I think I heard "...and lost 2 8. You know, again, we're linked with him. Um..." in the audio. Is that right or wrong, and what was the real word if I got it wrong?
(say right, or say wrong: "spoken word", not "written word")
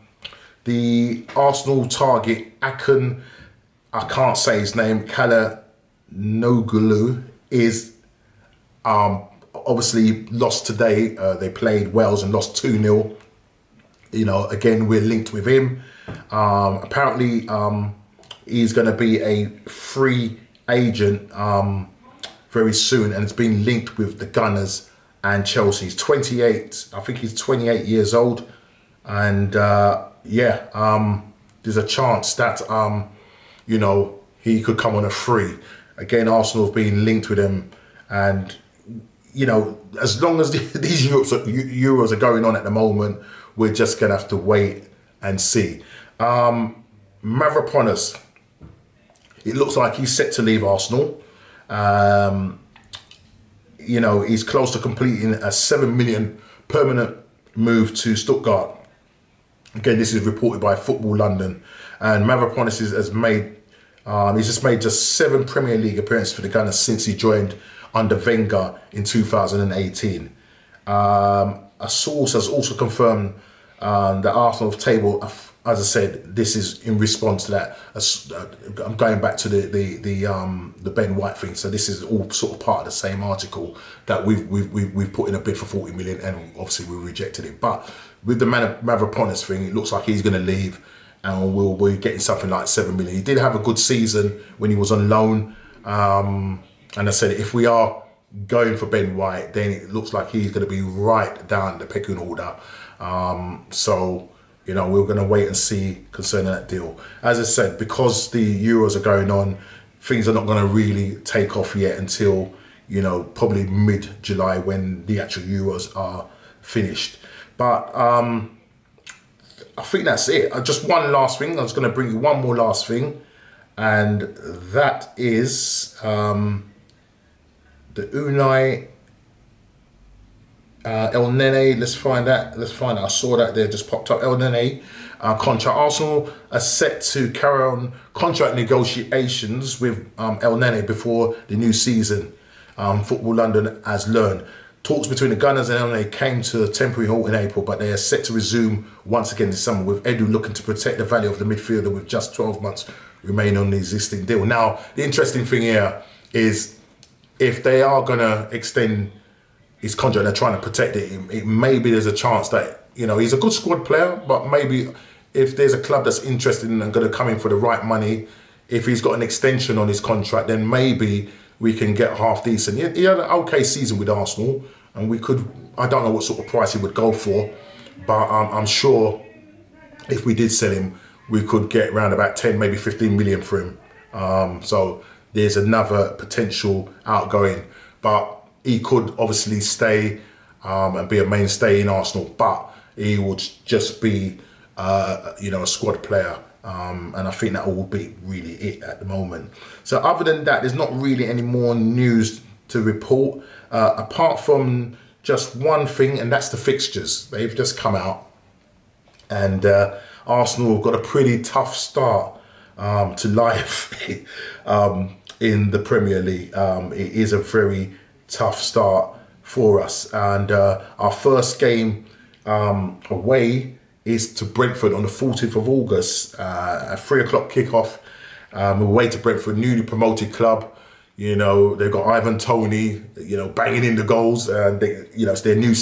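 wrong: "0", not "8".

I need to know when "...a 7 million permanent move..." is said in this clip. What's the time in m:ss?
0:55.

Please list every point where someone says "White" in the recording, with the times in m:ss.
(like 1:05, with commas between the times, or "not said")
1:21, 1:39.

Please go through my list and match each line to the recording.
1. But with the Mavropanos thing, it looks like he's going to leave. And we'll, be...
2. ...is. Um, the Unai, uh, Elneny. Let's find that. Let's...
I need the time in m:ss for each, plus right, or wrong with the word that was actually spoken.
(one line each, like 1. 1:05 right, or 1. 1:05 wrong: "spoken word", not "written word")
1. 1:27 right
2. 2:05 right.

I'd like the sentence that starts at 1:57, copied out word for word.
But um, I think that's it.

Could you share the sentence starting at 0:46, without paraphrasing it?
Um, Mavropanos, it looks like he's set to leave Arsenal.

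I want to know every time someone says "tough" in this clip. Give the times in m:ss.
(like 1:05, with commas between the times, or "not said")
3:31, 3:38.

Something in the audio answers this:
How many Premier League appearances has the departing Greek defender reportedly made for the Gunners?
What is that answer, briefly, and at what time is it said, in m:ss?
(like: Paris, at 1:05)
7, at 1:05.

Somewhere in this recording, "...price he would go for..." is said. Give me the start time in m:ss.
2:56.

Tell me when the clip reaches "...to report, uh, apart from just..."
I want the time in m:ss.
3:22.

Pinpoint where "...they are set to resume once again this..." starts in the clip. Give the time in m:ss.
2:27.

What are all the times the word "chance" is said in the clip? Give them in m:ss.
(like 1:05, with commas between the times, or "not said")
0:31, 2:42.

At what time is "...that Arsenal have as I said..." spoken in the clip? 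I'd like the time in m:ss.
1:14.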